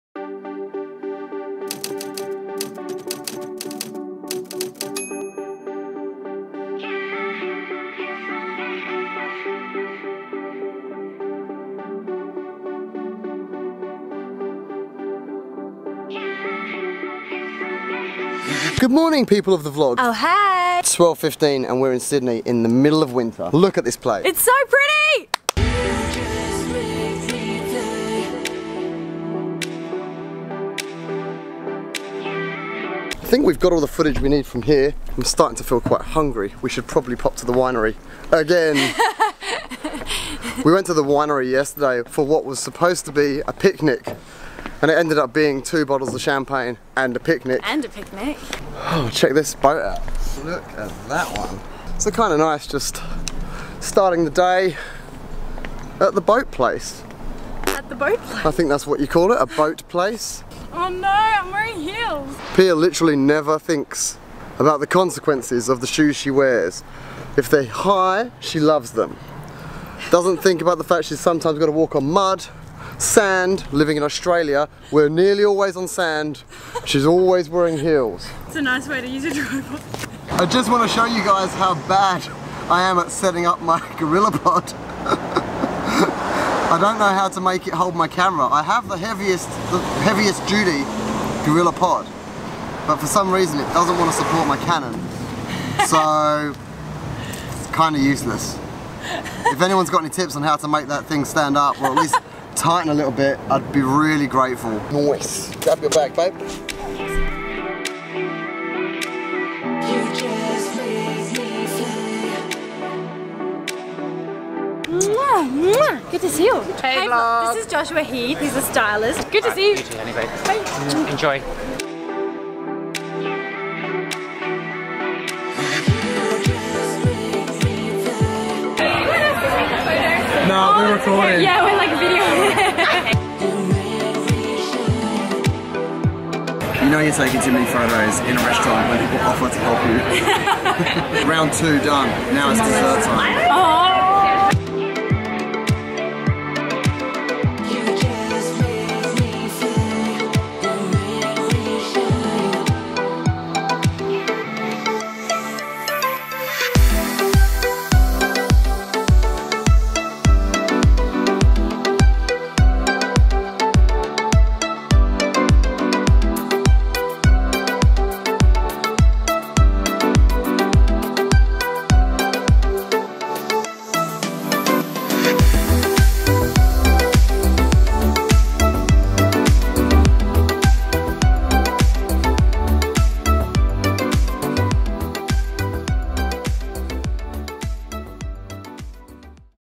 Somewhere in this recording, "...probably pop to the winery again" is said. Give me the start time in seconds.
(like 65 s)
36 s.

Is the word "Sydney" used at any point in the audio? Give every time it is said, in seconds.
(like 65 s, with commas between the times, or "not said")
21 s.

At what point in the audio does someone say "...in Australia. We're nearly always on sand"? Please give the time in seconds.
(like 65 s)
73 s.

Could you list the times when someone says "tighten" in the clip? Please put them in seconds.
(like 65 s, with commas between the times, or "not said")
102 s.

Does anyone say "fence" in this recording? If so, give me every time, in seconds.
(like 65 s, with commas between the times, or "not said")
not said.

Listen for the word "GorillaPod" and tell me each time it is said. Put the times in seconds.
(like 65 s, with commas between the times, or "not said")
83 s, 91 s.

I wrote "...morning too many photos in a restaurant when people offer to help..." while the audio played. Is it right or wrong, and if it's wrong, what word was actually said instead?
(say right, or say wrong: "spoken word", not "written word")
wrong: "taking", not "morning".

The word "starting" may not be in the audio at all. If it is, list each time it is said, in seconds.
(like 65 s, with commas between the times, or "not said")
35 s, 53 s.